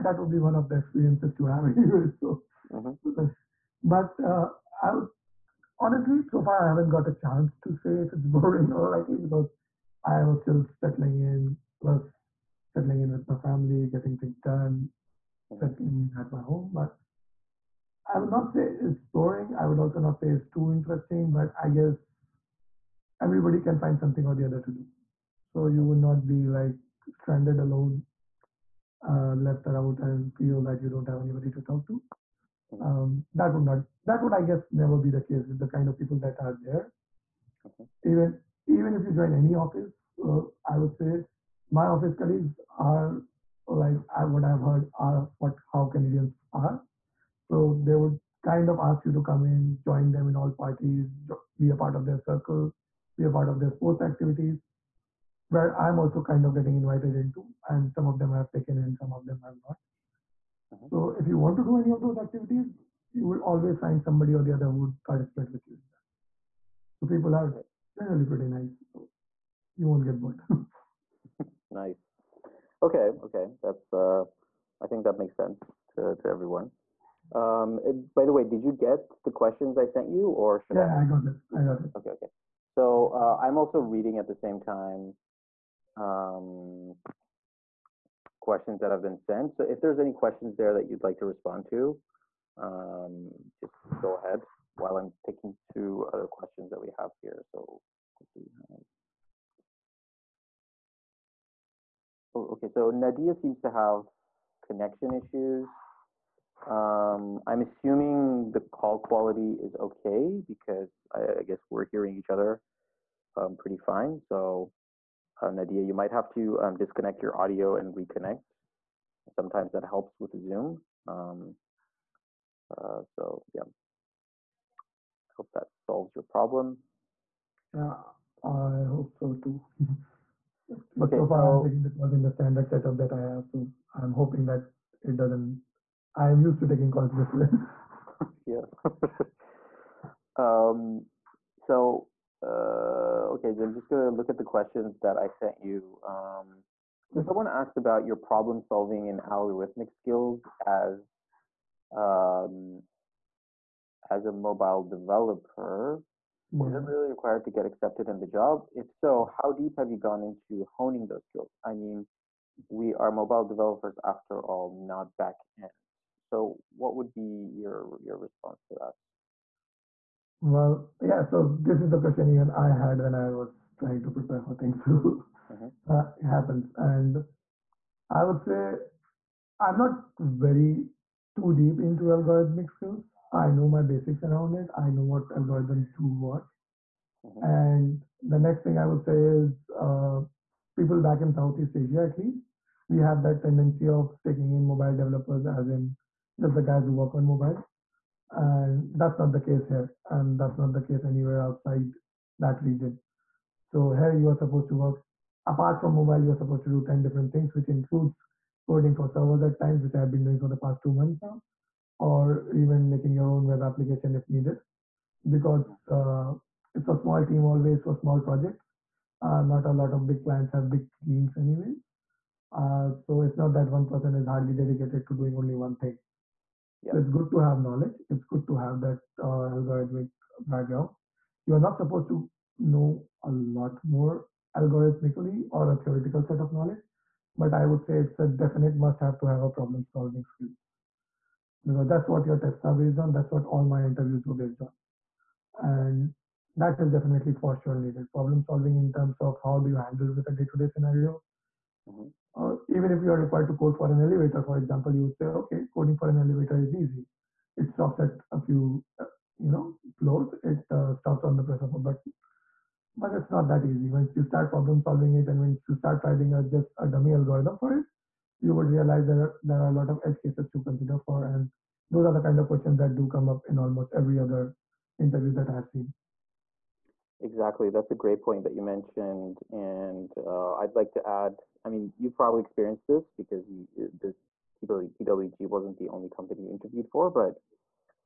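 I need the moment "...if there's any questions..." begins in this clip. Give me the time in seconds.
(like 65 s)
89 s.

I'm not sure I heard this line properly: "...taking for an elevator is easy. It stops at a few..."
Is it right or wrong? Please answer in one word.
wrong.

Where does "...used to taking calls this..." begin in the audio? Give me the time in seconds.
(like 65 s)
136 s.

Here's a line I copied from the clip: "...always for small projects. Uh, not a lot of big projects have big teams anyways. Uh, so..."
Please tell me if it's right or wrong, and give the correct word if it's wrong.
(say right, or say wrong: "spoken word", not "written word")
wrong: "clients", not "projects".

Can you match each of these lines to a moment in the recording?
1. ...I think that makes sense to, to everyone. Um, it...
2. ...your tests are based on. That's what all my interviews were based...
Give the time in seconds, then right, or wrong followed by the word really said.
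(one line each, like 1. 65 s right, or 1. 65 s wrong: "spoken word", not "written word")
1. 74 s right
2. 242 s right.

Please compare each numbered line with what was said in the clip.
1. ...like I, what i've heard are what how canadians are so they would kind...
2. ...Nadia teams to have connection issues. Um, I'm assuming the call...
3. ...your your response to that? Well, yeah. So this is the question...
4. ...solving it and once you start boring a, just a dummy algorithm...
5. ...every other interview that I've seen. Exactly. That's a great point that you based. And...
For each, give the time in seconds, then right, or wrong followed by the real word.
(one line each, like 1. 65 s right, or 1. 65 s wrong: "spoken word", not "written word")
1. 43 s right
2. 102 s wrong: "seems", not "teams"
3. 167 s right
4. 264 s wrong: "writing", not "boring"
5. 273 s wrong: "mentioned", not "based".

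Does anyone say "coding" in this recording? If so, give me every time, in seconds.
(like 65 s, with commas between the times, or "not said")
208 s, 255 s.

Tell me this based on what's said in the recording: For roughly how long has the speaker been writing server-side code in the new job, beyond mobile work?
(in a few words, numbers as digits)
2 months.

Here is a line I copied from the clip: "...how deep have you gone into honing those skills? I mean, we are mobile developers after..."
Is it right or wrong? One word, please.
right.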